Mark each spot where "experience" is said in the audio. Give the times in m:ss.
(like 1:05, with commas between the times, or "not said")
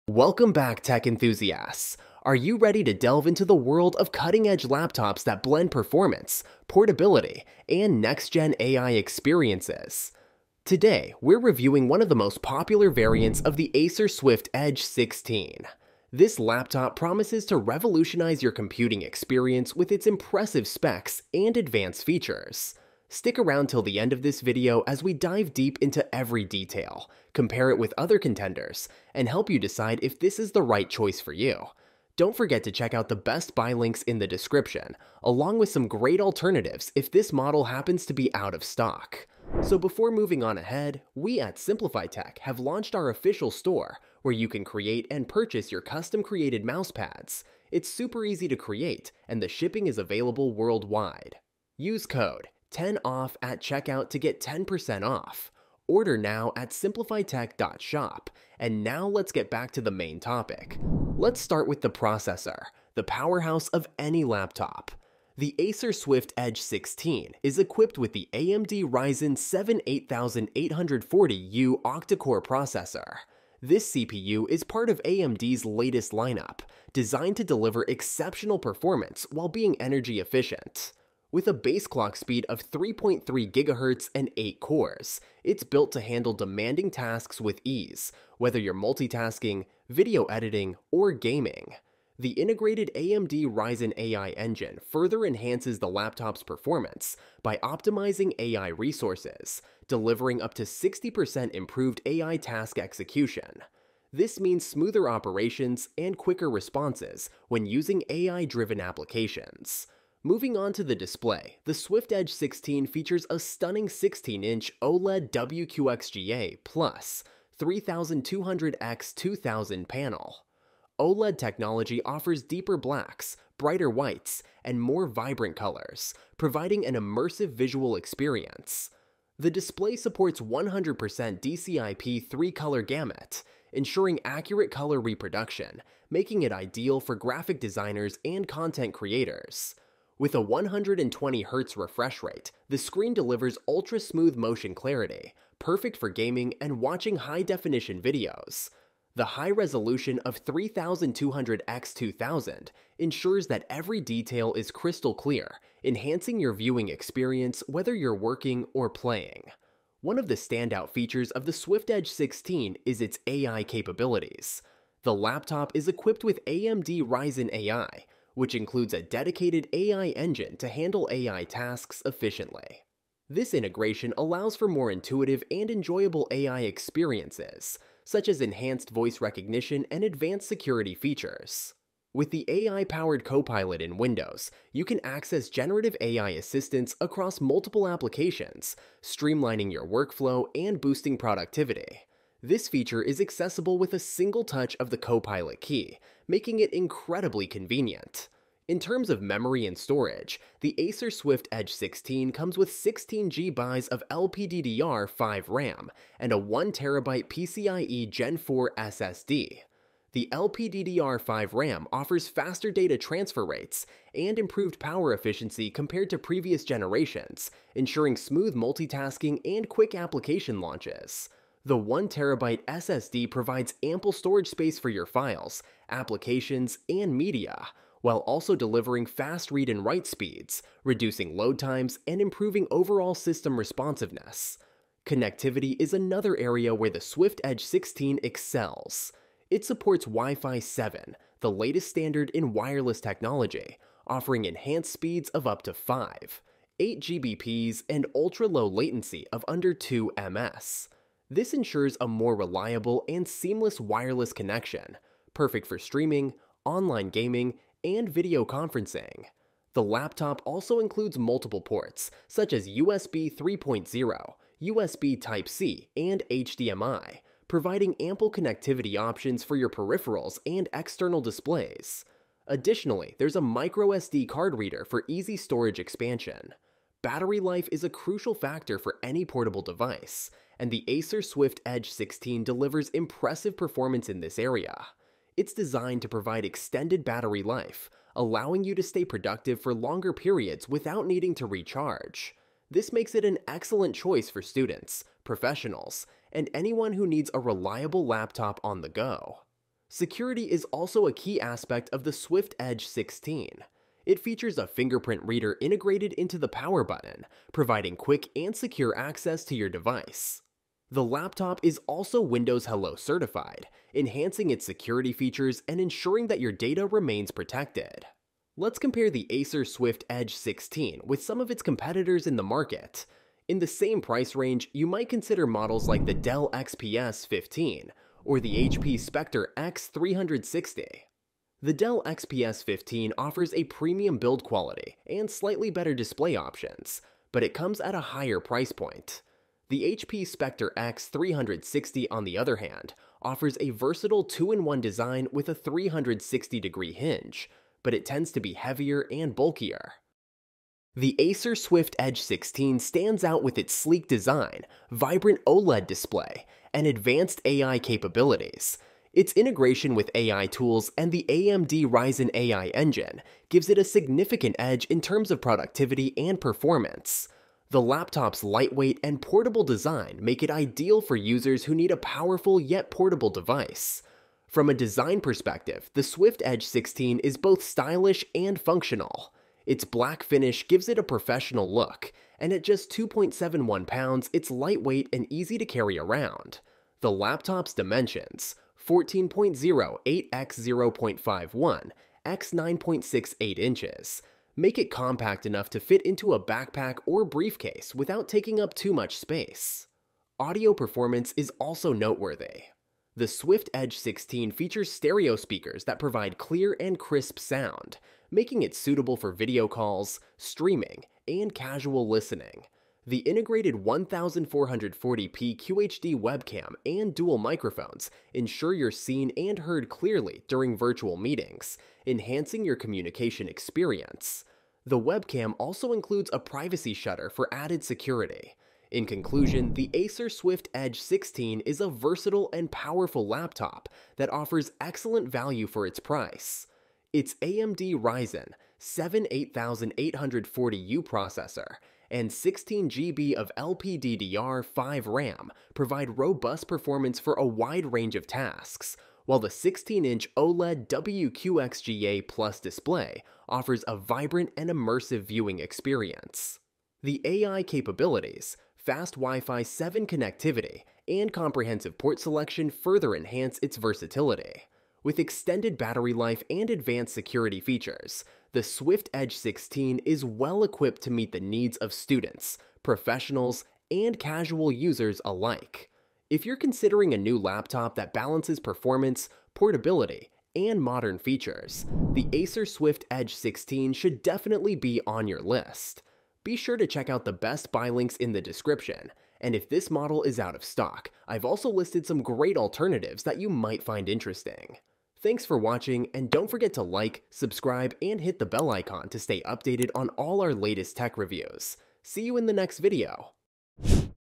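0:08, 0:19, 2:07, 2:36, 2:56, 7:03, 7:35.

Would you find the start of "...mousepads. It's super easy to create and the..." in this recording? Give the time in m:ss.
0:46.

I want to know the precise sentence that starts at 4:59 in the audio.
Security is also a key aspect of the Swift Edge 16.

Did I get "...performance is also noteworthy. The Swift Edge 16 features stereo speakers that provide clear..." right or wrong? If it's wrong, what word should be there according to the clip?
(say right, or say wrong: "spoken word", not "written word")
right.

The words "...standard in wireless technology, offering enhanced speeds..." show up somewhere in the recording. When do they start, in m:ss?
4:01.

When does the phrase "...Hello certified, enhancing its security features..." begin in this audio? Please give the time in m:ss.
5:12.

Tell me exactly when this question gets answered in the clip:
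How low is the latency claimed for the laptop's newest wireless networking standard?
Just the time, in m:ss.
4:09.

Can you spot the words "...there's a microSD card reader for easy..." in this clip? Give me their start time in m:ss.
4:33.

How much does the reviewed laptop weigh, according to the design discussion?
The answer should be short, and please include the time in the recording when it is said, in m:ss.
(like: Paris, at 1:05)
2.71 pounds, at 6:22.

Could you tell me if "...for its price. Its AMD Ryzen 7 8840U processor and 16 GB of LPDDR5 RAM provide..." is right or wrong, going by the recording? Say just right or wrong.
right.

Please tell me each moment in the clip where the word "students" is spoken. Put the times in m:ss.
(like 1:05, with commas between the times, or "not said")
4:54, 7:51.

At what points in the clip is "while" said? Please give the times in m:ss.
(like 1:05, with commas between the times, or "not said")
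1:19, 3:48, 7:29.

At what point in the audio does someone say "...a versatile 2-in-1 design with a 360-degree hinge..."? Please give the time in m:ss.
5:43.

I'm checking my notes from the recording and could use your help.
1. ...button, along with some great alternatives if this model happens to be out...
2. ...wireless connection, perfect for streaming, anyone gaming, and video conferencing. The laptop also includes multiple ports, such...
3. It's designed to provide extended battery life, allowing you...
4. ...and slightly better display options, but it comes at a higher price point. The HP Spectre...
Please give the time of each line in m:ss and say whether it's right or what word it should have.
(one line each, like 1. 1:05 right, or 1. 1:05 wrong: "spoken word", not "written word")
1. 0:34 wrong: "description", not "button"
2. 4:13 wrong: "online", not "anyone"
3. 4:45 right
4. 5:35 right.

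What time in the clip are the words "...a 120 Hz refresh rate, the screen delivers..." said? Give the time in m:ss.
2:20.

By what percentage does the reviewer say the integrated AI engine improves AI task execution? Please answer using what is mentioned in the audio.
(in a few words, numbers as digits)
60%.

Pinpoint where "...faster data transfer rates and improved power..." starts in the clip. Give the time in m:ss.
3:32.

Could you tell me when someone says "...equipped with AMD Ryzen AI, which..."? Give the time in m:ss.
2:45.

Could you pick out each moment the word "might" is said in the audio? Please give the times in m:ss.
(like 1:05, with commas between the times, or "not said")
5:24, 8:13.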